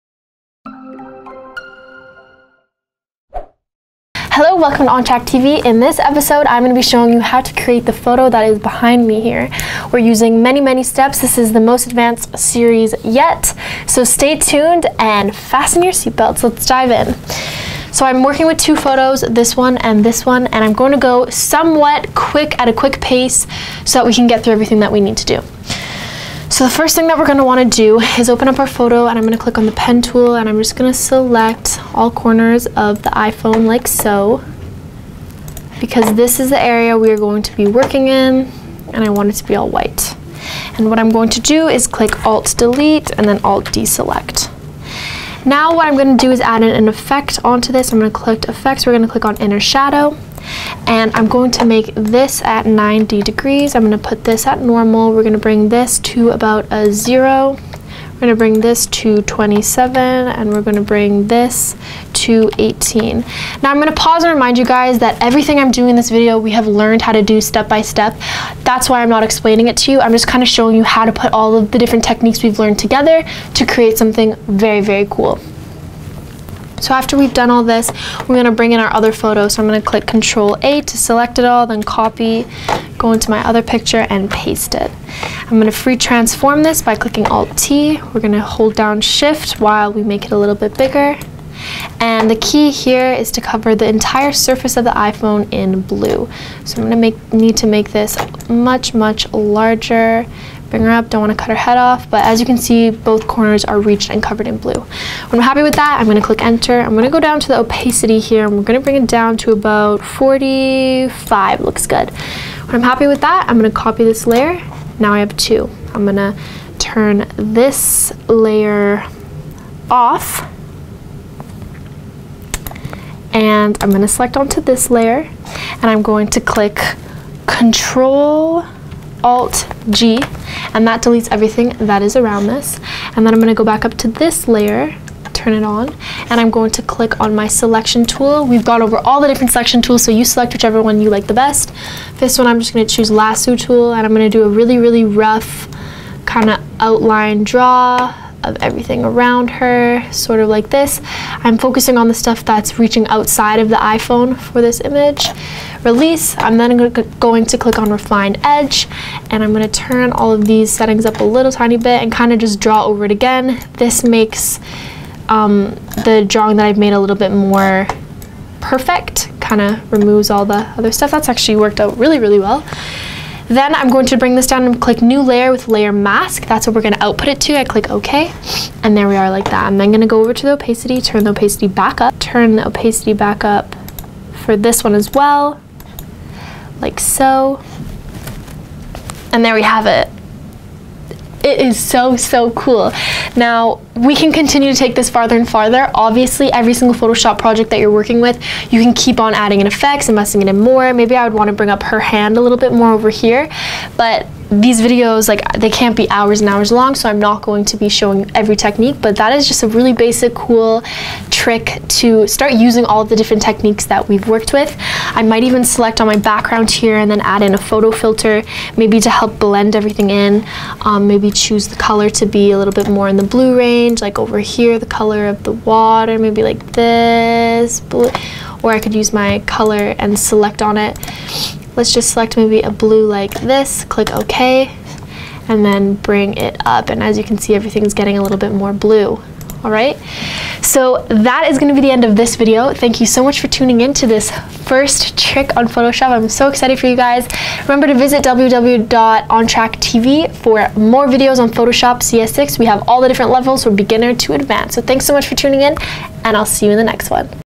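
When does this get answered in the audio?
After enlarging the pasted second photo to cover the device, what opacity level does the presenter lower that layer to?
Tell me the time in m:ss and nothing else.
1:49.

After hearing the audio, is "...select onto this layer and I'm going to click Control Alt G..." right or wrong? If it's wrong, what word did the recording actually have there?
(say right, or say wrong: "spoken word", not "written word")
right.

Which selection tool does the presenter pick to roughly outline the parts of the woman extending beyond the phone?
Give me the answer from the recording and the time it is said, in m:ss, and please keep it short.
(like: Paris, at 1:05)
Lasso tool, at 2:23.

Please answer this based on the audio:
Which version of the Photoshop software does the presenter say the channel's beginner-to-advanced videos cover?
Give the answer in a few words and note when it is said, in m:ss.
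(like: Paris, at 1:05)
CS6, at 4:11.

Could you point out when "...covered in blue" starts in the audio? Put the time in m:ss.
1:44.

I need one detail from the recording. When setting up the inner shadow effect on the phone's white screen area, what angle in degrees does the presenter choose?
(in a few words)
90.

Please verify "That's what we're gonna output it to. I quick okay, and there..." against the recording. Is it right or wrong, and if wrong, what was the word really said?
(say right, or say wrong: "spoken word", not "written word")
wrong: "click", not "quick".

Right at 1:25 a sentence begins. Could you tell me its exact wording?
I'm gonna free transform this by clicking Alt T.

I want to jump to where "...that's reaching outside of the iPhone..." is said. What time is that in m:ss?
2:32.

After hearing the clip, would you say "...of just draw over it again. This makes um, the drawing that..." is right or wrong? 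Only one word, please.
right.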